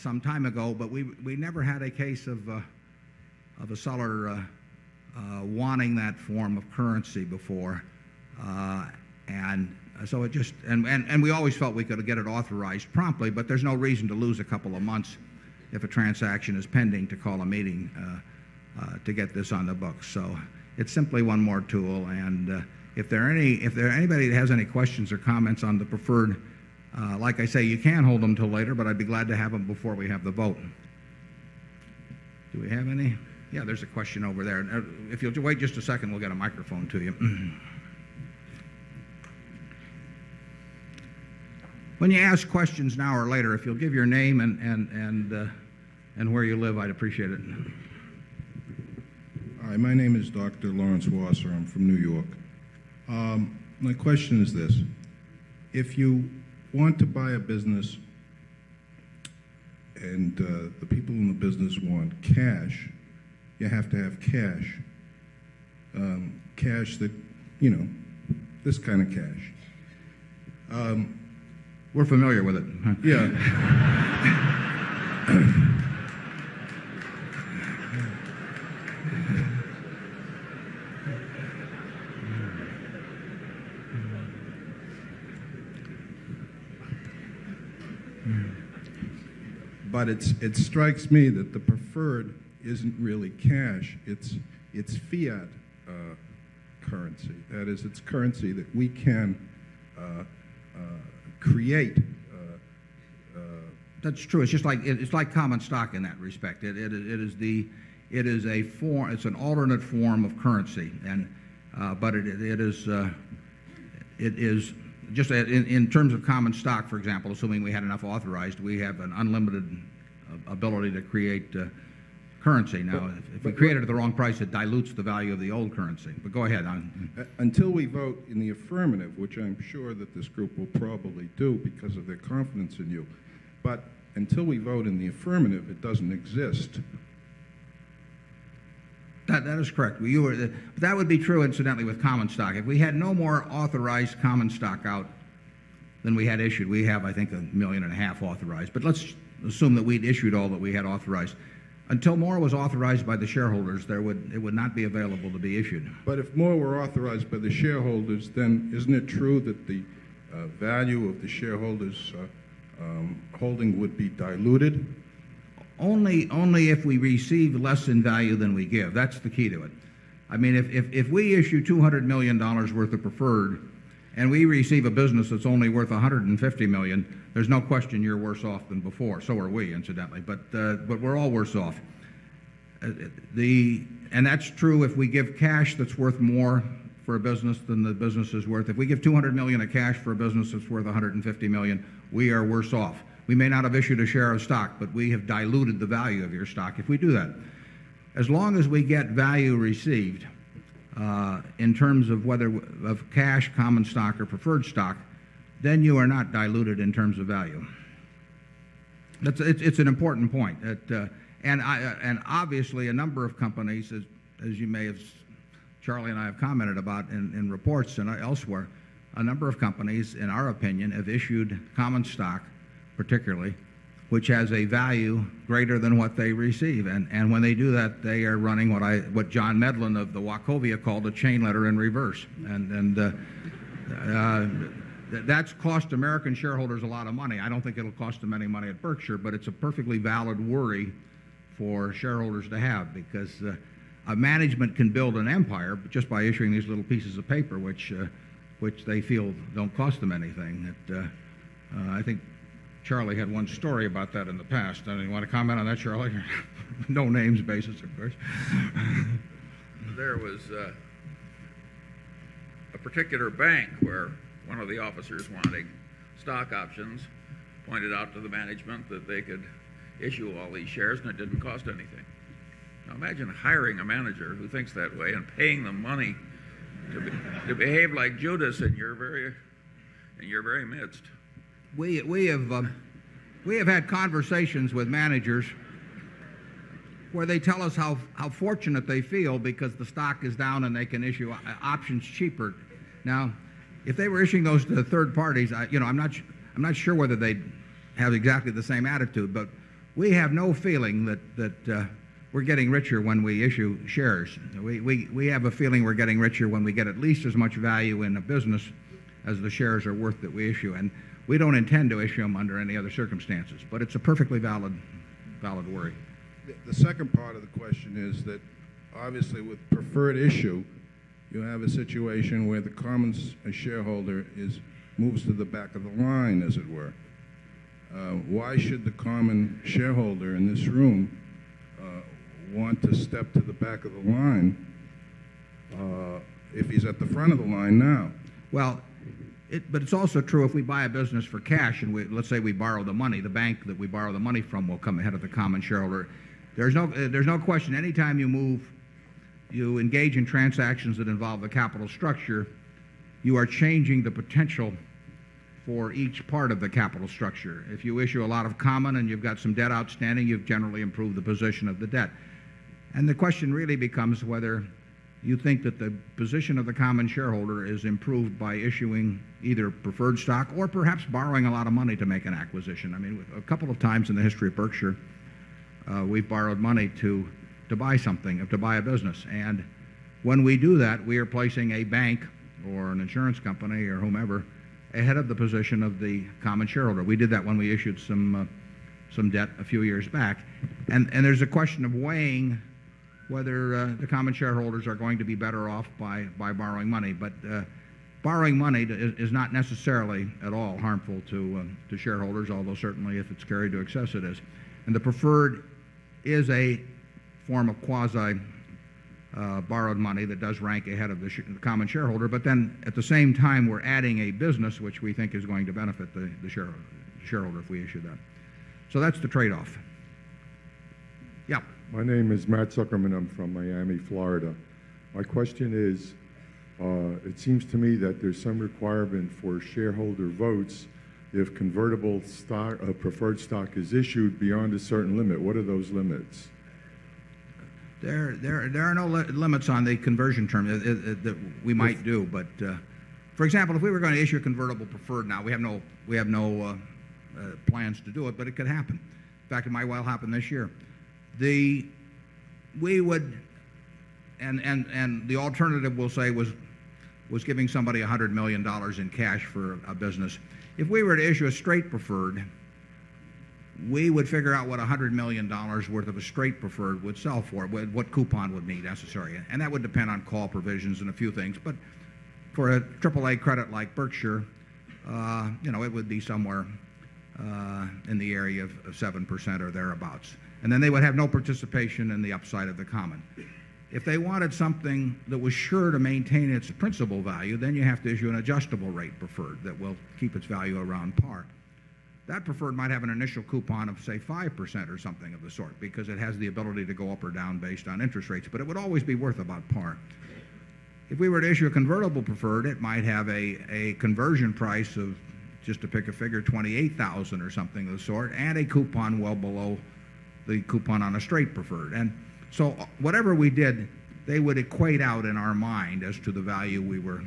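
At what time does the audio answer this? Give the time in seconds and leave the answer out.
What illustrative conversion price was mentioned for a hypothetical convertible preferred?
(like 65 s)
506 s.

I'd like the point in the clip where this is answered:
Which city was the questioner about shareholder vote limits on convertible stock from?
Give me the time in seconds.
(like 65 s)
423 s.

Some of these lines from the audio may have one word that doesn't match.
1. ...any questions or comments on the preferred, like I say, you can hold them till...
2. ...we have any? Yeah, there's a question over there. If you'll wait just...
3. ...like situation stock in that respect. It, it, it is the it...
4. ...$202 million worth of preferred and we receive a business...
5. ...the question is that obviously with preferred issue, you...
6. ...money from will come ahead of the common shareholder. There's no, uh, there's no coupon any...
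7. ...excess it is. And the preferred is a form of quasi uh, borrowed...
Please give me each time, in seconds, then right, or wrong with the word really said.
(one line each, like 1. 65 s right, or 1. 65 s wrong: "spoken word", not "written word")
1. 24 s right
2. 32 s right
3. 105 s wrong: "common", not "situation"
4. 171 s wrong: "200", not "202"
5. 317 s right
6. 344 s wrong: "question", not "coupon"
7. 403 s right.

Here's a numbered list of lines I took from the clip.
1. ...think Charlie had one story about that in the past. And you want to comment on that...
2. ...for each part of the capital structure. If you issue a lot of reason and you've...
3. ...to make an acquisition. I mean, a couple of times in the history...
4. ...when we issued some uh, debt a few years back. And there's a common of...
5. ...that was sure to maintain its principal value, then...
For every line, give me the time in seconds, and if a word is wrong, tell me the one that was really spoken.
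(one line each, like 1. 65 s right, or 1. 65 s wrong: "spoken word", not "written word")
1. 252 s right
2. 355 s wrong: "common", not "reason"
3. 371 s right
4. 387 s wrong: "question", not "common"
5. 485 s right.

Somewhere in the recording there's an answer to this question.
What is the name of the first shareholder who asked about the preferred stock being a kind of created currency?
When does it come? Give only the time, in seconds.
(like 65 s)
50 s.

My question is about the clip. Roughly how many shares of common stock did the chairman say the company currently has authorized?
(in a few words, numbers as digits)
a million and a half.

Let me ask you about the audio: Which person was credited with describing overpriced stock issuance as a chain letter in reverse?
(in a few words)
John Medlin.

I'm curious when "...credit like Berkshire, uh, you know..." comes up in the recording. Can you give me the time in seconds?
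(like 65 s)
473 s.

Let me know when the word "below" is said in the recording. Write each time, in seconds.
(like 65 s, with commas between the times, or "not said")
509 s.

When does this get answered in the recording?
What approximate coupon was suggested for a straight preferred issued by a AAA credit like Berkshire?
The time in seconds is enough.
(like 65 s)
478 s.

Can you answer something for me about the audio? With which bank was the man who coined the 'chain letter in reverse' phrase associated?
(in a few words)
Wachovia.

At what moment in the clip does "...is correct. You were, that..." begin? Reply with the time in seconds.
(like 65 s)
139 s.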